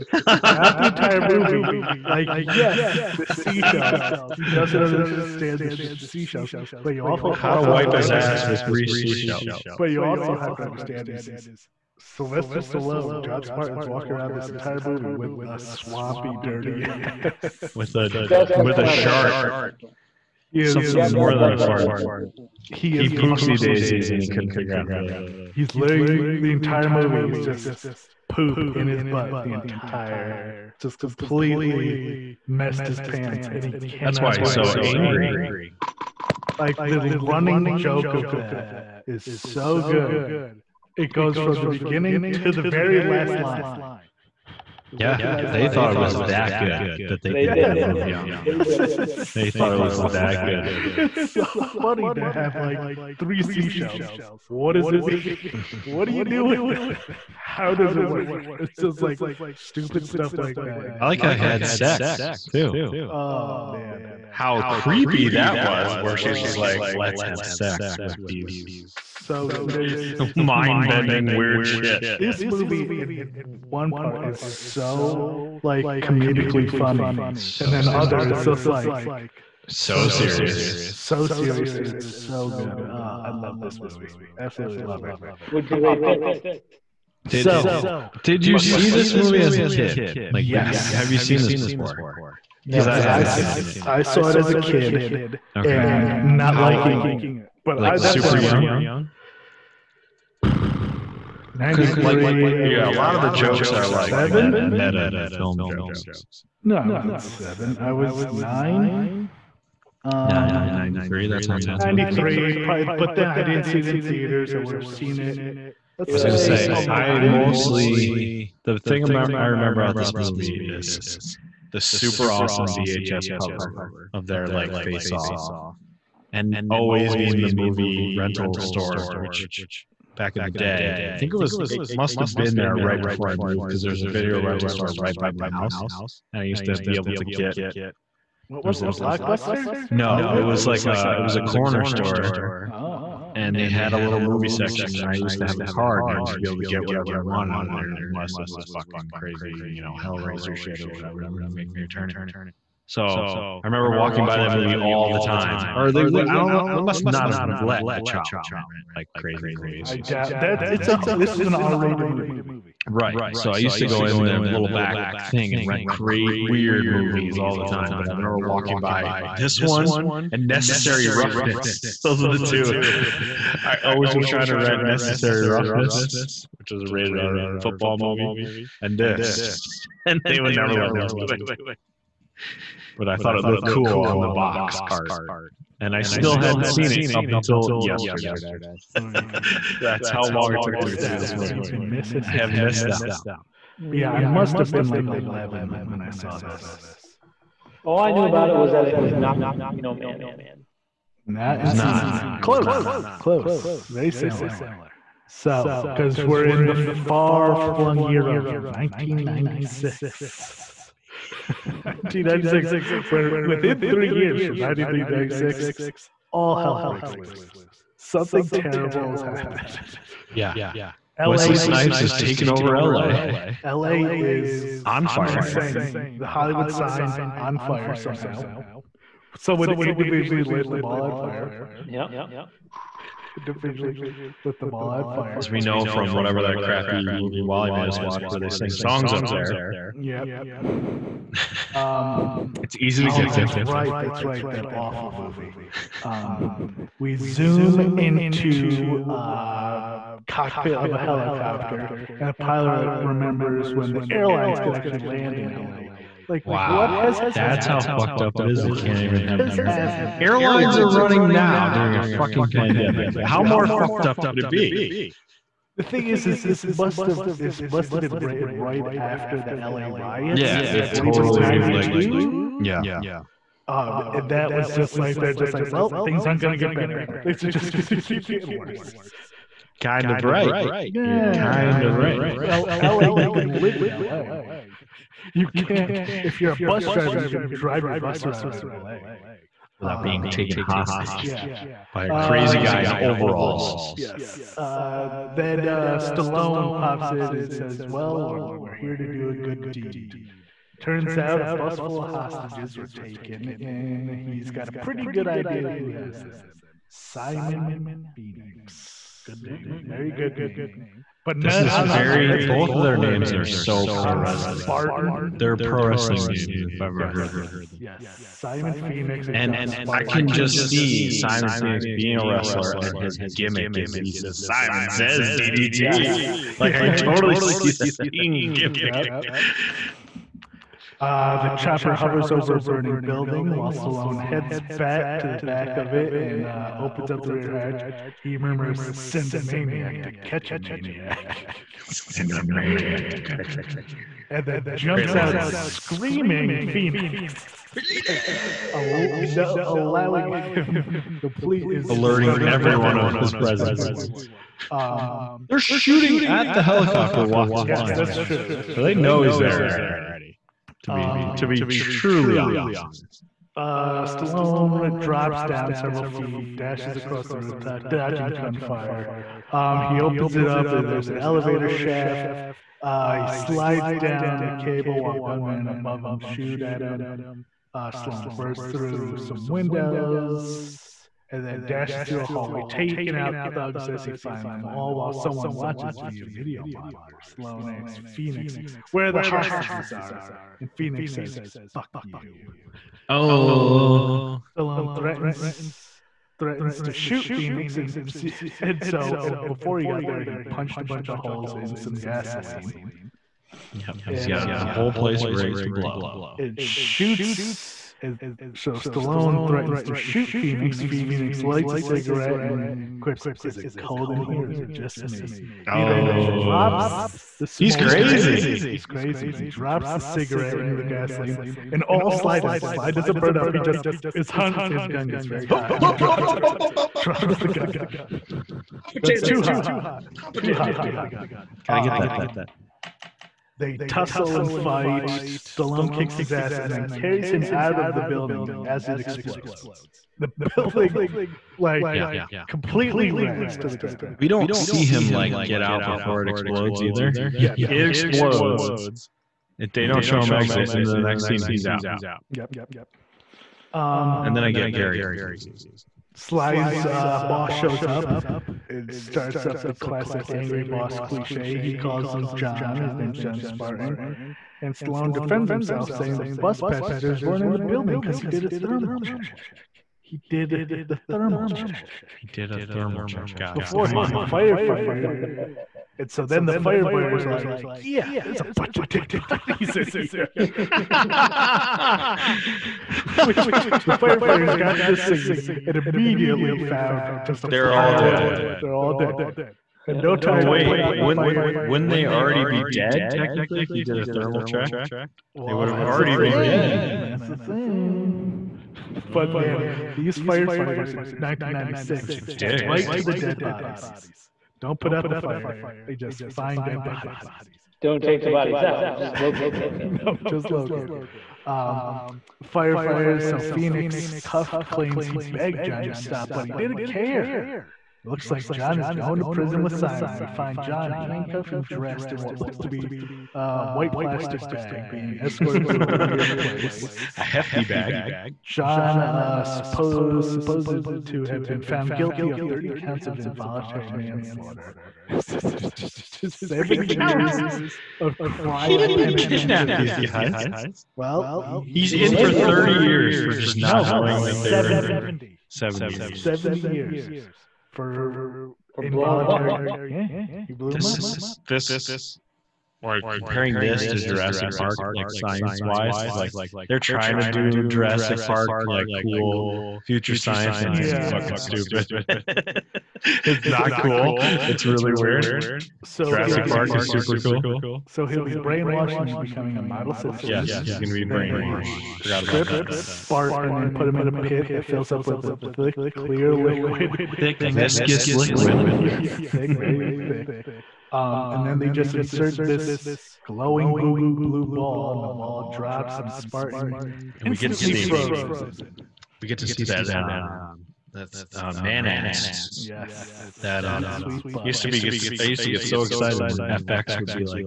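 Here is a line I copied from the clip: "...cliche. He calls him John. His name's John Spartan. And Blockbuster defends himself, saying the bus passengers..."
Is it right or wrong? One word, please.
wrong.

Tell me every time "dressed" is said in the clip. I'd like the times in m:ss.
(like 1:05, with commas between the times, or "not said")
8:41.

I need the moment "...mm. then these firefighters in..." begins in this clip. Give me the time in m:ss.
8:19.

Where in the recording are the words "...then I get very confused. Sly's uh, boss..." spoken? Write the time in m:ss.
7:34.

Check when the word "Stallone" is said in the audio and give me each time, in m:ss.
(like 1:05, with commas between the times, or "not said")
0:12, 4:55, 5:33, 6:04, 6:34, 6:48, 7:15, 7:44.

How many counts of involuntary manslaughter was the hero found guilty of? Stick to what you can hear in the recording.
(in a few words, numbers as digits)
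30.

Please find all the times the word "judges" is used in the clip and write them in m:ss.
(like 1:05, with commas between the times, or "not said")
not said.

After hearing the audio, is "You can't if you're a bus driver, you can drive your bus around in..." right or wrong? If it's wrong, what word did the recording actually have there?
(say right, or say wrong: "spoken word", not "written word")
right.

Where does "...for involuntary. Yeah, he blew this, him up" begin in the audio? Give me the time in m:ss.
9:08.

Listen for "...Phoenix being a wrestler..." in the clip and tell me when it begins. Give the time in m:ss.
5:21.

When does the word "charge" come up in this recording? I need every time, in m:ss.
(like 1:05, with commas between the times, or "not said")
not said.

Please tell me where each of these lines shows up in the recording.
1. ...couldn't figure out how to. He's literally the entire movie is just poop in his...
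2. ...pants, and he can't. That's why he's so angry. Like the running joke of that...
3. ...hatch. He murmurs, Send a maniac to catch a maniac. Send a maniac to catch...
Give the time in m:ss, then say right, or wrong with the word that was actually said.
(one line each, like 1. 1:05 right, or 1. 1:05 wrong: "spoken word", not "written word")
1. 0:24 right
2. 0:33 right
3. 5:37 right.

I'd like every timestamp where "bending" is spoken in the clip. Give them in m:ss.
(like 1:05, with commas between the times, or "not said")
1:10.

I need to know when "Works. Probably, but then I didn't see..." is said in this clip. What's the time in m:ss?
1:52.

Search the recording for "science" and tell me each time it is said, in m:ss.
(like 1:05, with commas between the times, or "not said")
9:15, 9:20.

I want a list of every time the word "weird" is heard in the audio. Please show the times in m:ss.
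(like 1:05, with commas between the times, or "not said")
1:11, 2:46, 8:46, 9:24.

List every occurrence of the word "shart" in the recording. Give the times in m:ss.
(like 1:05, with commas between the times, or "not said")
0:18.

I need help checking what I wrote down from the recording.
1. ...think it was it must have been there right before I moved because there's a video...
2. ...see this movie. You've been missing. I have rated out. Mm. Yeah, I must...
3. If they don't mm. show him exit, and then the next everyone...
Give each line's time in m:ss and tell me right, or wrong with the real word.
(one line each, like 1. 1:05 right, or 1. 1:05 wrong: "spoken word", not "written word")
1. 2:11 right
2. 3:10 wrong: "missed", not "rated"
3. 7:29 wrong: "scene", not "everyone".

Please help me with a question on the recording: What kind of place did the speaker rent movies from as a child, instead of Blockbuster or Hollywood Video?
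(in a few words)
a corner store.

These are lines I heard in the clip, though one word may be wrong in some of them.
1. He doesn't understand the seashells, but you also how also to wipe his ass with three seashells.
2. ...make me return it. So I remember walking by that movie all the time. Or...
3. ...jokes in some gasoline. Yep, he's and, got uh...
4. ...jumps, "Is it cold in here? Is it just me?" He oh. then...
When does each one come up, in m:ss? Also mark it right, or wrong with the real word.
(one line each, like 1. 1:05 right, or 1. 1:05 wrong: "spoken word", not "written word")
1. 0:04 right
2. 2:31 right
3. 6:41 wrong: "holes", not "jokes"
4. 6:52 wrong: "quips", not "jumps".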